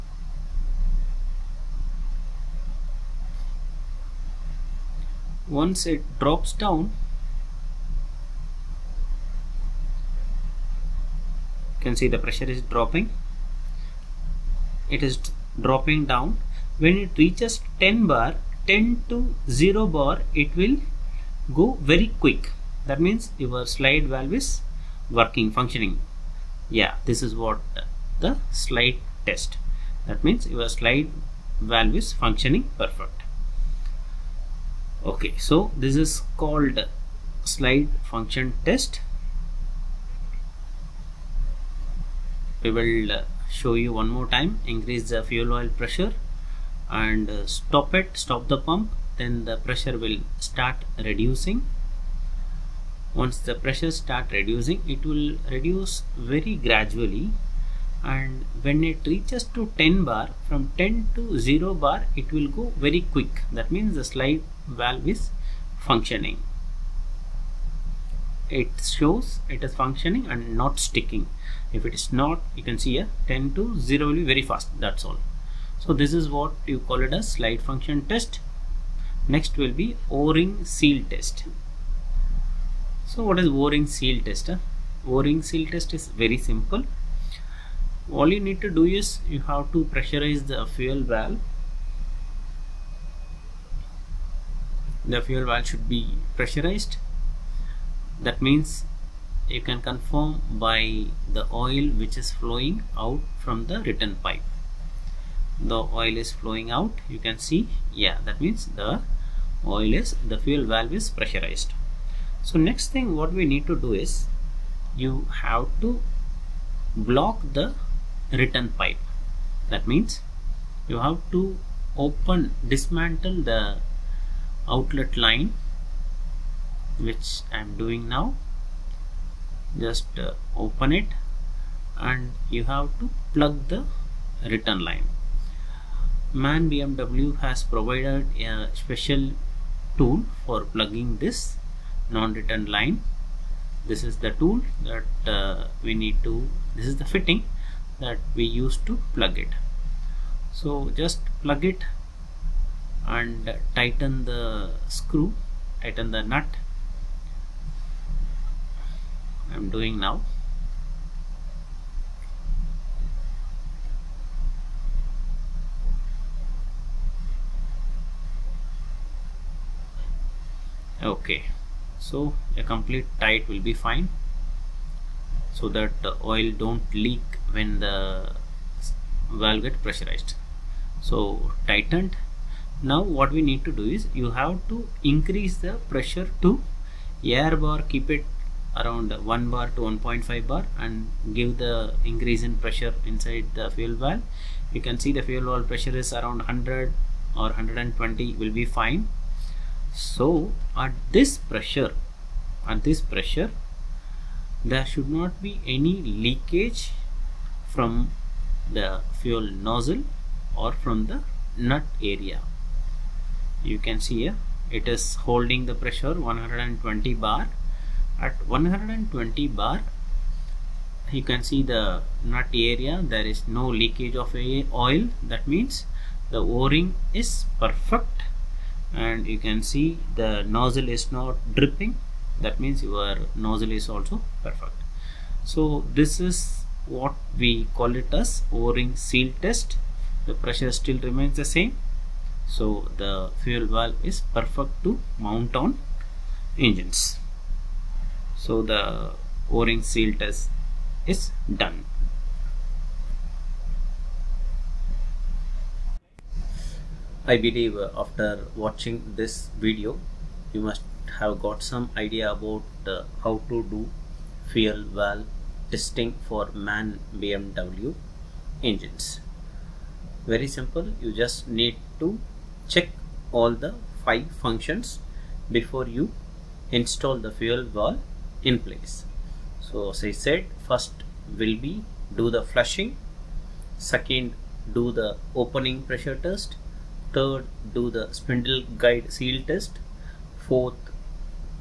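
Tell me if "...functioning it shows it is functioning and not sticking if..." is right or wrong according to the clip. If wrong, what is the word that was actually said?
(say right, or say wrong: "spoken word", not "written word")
right.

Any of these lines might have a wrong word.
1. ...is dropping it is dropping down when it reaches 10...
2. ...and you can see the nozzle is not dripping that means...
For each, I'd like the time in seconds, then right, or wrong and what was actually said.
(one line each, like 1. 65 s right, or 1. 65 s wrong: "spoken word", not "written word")
1. 12 s right
2. 229 s right.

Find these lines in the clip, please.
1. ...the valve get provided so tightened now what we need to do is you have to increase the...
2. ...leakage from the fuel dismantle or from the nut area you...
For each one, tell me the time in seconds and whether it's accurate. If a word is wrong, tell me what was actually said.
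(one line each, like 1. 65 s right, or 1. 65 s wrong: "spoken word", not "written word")
1. 177 s wrong: "pressurized", not "provided"
2. 206 s wrong: "nozzle", not "dismantle".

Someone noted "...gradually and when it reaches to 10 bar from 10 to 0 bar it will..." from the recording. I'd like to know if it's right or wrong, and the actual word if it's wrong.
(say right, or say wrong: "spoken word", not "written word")
right.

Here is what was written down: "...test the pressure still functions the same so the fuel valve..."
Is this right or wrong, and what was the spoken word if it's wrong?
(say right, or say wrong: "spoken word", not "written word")
wrong: "remains", not "functions".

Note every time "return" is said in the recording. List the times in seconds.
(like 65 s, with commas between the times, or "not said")
103 s, 118 s, 134 s, 142 s.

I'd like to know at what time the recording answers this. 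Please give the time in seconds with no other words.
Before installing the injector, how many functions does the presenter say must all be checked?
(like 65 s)
274 s.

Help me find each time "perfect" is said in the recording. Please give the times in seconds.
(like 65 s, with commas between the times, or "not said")
32 s, 227 s, 234 s, 244 s.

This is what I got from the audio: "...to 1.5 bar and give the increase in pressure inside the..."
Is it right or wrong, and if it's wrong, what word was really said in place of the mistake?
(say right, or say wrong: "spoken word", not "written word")
right.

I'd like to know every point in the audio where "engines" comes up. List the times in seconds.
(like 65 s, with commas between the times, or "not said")
246 s, 268 s.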